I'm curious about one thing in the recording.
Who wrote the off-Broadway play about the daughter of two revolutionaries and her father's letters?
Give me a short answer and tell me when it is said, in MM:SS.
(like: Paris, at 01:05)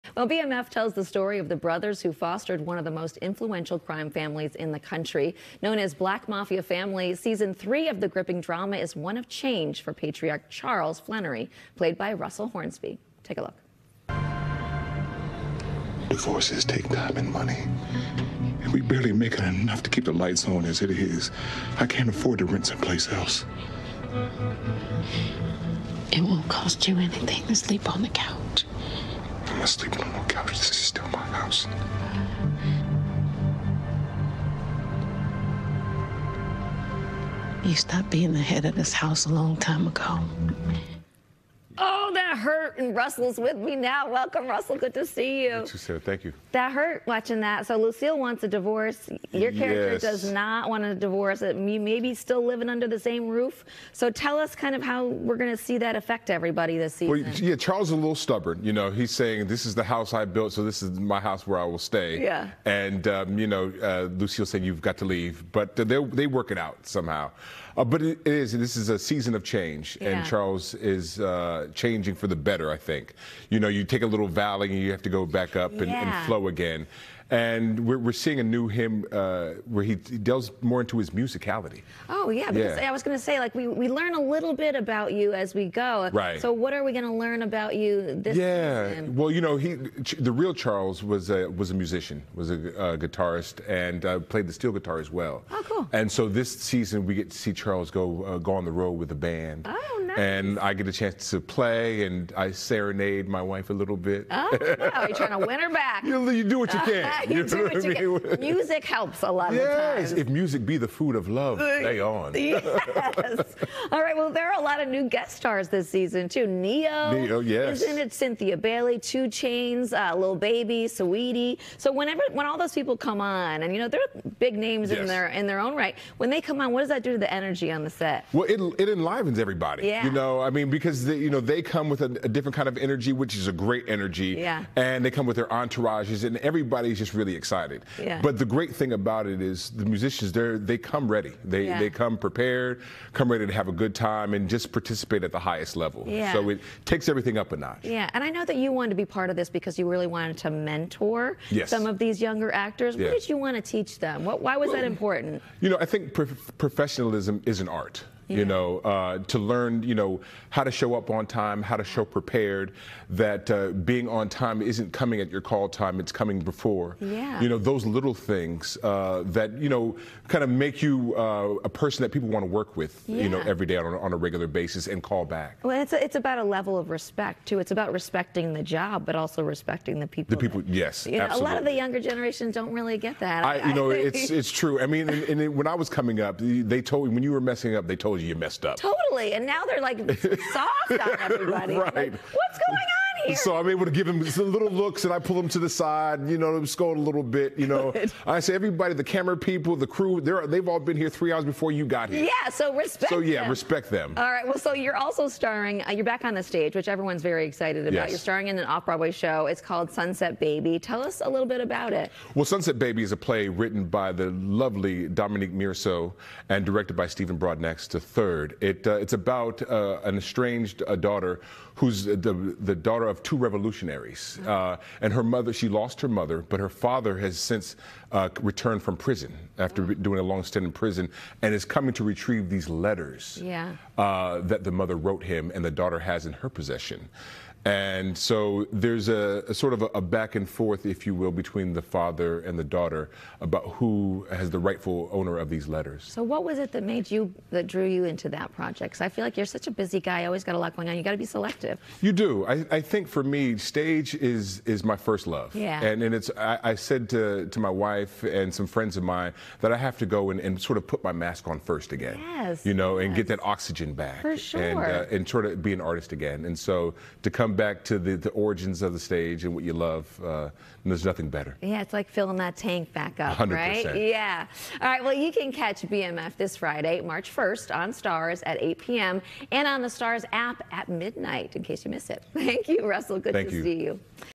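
Dominique Morisseau, at 03:35.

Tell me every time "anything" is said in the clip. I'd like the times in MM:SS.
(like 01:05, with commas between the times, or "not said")
00:26.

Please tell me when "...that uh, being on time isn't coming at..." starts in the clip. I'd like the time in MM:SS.
02:43.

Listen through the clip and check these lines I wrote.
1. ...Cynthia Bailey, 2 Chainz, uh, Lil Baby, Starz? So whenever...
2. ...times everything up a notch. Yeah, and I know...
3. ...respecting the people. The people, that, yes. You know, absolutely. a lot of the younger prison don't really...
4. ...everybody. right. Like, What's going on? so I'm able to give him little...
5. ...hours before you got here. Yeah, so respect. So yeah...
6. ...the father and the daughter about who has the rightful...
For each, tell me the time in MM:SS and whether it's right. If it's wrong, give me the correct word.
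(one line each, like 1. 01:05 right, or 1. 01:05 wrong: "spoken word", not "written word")
1. 01:58 wrong: "Saweetie", not "Starz"
2. 02:26 wrong: "takes", not "times"
3. 02:59 wrong: "generation", not "prison"
4. 03:11 right
5. 03:21 right
6. 04:01 right.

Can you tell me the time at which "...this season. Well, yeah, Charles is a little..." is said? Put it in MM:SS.
00:56.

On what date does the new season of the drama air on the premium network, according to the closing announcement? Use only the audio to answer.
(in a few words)
March 1.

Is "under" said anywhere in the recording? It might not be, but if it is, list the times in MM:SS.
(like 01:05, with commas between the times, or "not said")
00:52.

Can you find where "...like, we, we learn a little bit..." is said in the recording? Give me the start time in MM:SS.
01:23.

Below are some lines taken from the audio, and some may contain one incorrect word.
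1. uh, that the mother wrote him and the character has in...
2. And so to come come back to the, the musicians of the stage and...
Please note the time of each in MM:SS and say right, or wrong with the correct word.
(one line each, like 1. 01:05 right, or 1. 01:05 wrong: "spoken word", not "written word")
1. 03:53 wrong: "daughter", not "character"
2. 04:26 wrong: "origins", not "musicians".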